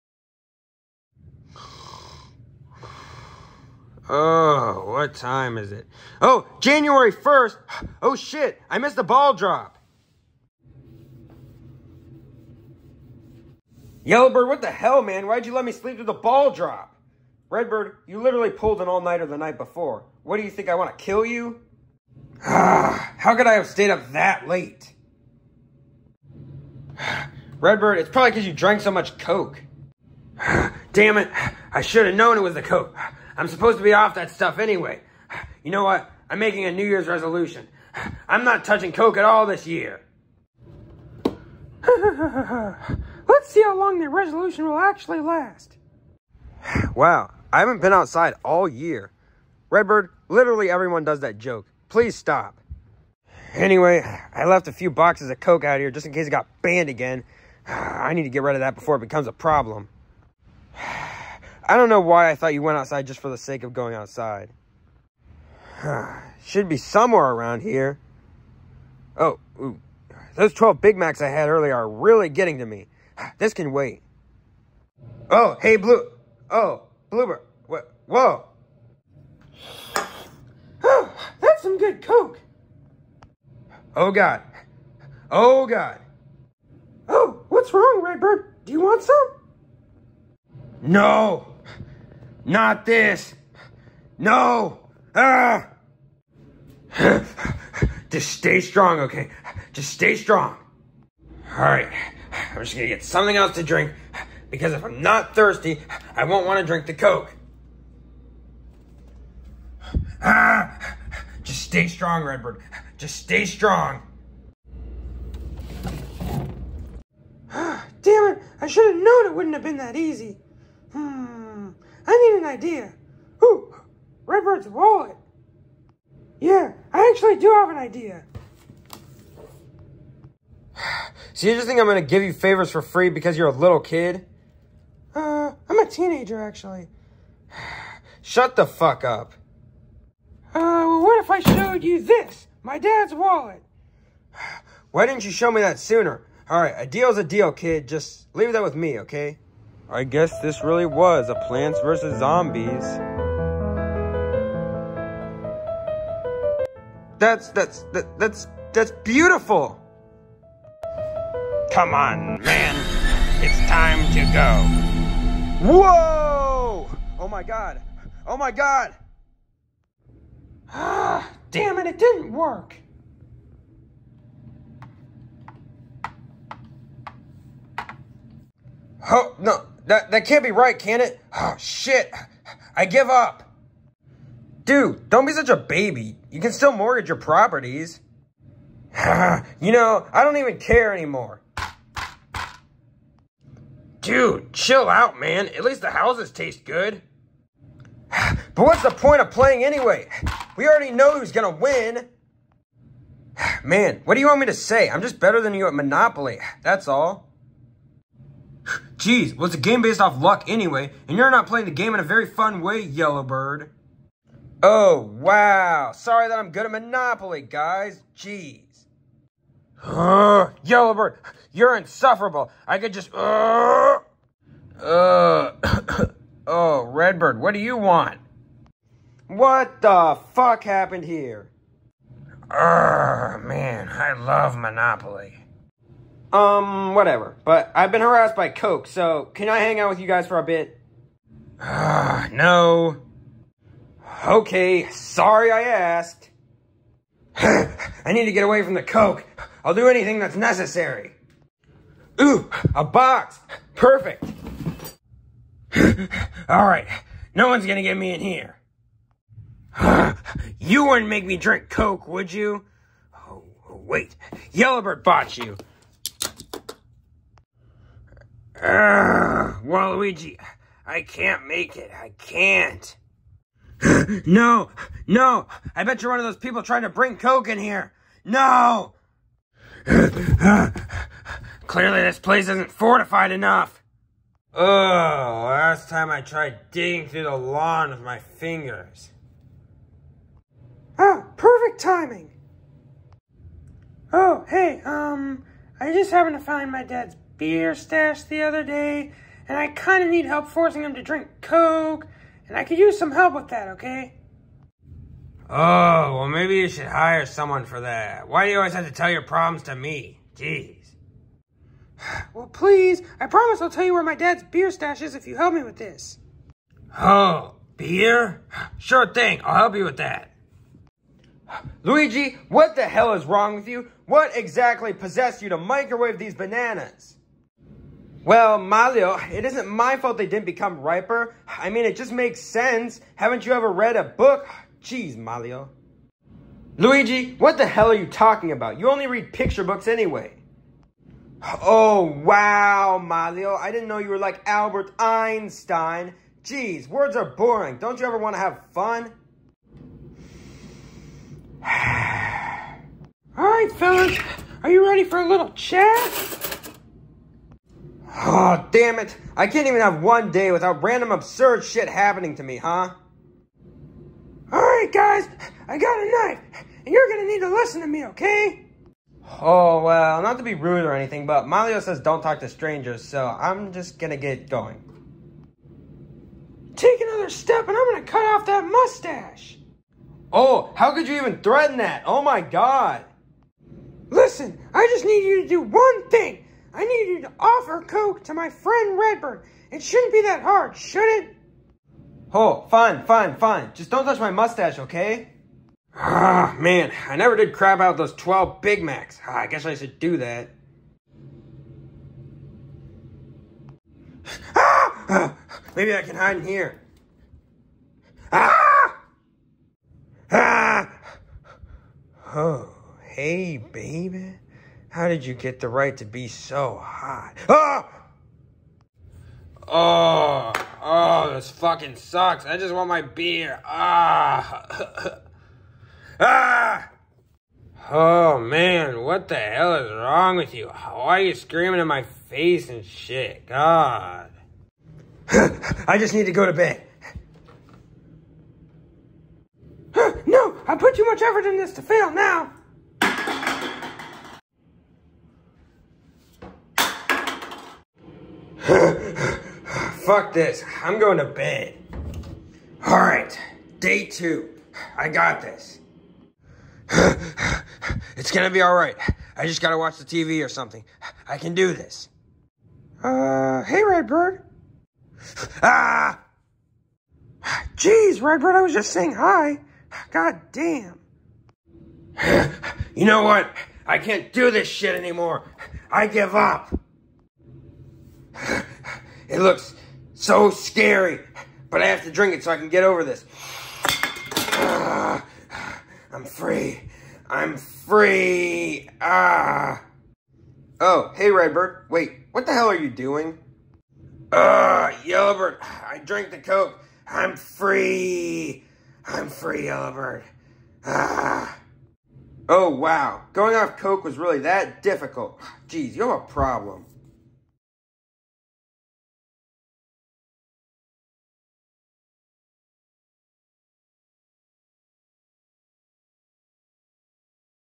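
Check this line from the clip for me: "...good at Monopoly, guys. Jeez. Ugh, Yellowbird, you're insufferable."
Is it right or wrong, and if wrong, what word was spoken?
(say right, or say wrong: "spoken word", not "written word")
right.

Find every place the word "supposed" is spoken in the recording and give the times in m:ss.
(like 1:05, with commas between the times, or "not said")
0:33.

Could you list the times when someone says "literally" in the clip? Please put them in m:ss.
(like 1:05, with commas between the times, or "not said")
0:18, 0:50.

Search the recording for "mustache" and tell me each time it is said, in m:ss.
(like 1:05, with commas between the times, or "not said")
6:18, 6:34.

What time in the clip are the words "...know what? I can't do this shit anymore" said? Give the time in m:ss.
7:53.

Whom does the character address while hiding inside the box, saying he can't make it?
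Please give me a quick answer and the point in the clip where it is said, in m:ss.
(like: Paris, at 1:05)
Waluigi, at 4:29.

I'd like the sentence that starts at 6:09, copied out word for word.
Oh, well, not to be rude or anything, but Malio says don't talk to strangers, so I'm just gonna get going.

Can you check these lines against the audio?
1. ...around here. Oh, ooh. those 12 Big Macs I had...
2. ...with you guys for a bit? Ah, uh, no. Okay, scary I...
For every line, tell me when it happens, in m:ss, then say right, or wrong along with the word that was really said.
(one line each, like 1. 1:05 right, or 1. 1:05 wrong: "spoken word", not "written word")
1. 1:07 right
2. 3:59 wrong: "sorry", not "scary".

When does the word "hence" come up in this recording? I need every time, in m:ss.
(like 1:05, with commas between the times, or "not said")
not said.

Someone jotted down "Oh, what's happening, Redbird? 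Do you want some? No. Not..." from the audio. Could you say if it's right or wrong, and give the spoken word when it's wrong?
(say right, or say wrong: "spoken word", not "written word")
wrong: "wrong", not "happening".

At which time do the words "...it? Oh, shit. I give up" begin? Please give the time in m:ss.
3:01.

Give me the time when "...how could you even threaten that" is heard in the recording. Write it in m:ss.
6:20.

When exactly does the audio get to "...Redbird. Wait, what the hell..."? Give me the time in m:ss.
8:11.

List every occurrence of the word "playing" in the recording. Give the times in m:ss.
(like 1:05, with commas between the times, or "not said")
3:19, 3:31.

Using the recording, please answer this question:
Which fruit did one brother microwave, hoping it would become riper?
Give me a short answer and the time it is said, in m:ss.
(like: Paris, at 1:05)
bananas, at 5:26.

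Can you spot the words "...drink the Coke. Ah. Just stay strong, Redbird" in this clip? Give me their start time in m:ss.
1:46.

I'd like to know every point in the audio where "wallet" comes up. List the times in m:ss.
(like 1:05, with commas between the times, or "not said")
2:04, 2:23.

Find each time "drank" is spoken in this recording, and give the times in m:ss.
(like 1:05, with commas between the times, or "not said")
0:28, 8:16.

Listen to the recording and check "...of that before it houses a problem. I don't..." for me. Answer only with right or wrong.
wrong.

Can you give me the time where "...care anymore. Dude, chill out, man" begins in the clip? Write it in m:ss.
3:10.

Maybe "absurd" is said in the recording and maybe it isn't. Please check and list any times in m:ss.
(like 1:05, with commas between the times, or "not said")
6:01.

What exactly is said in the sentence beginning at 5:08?
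Why do you always have to tell your problems to me?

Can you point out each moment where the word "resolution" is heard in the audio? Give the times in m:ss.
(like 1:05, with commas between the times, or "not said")
0:37, 0:44.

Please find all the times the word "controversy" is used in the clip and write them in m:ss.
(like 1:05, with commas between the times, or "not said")
not said.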